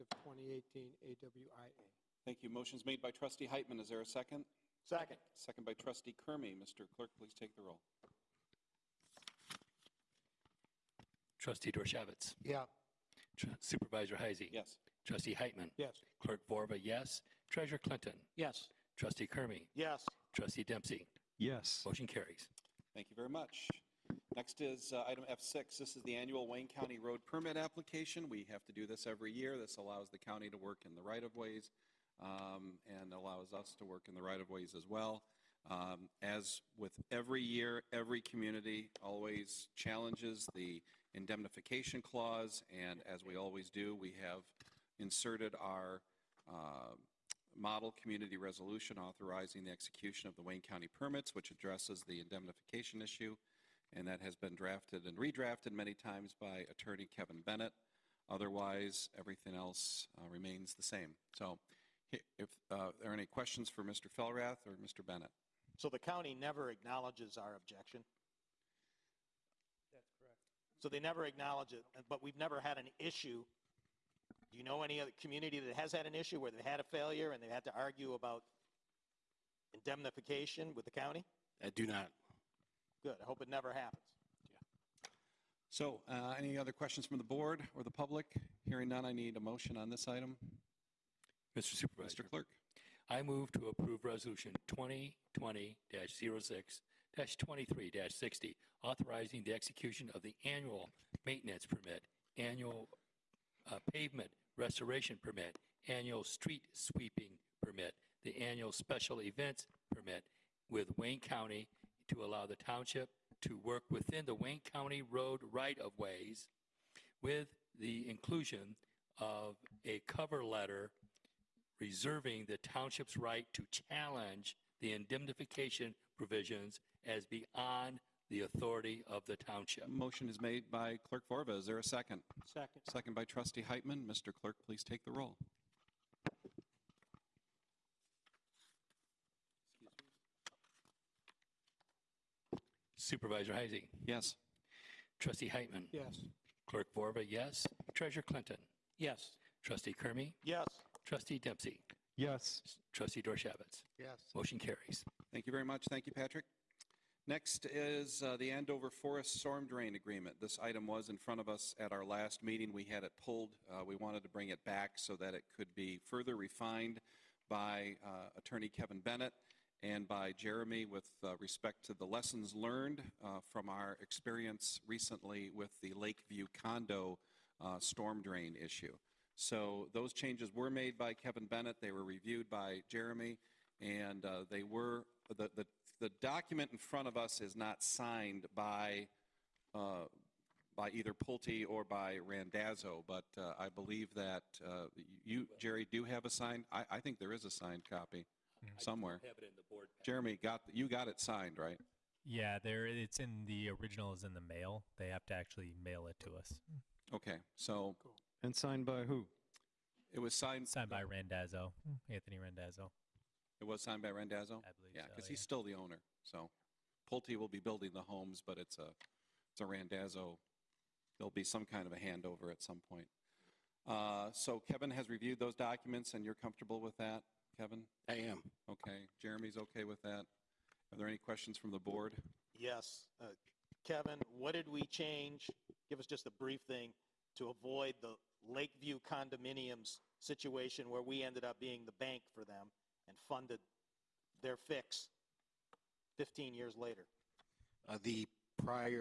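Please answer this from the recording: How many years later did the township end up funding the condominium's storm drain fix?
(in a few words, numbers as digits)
15.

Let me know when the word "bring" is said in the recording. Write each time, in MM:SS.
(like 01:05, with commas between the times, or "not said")
02:44.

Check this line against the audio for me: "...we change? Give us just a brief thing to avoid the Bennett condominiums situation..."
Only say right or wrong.
wrong.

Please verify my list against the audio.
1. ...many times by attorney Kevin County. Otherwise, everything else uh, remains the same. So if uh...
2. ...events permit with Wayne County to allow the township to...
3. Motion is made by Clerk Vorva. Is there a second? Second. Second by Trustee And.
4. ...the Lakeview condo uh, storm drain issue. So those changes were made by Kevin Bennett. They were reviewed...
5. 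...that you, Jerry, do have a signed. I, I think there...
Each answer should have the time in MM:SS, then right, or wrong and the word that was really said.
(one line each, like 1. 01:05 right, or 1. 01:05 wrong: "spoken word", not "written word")
1. 00:55 wrong: "Bennett", not "County"
2. 01:49 right
3. 02:09 wrong: "Heitman", not "And"
4. 02:55 right
5. 03:14 right.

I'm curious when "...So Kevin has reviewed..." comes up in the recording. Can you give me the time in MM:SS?
03:44.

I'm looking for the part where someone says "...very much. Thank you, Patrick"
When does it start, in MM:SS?
02:35.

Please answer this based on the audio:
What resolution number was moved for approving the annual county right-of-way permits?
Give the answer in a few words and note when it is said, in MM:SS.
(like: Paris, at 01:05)
2020 06 23 60, at 01:34.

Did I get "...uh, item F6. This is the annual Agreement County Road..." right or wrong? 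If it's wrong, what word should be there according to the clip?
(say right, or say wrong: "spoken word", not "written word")
wrong: "Wayne", not "Agreement".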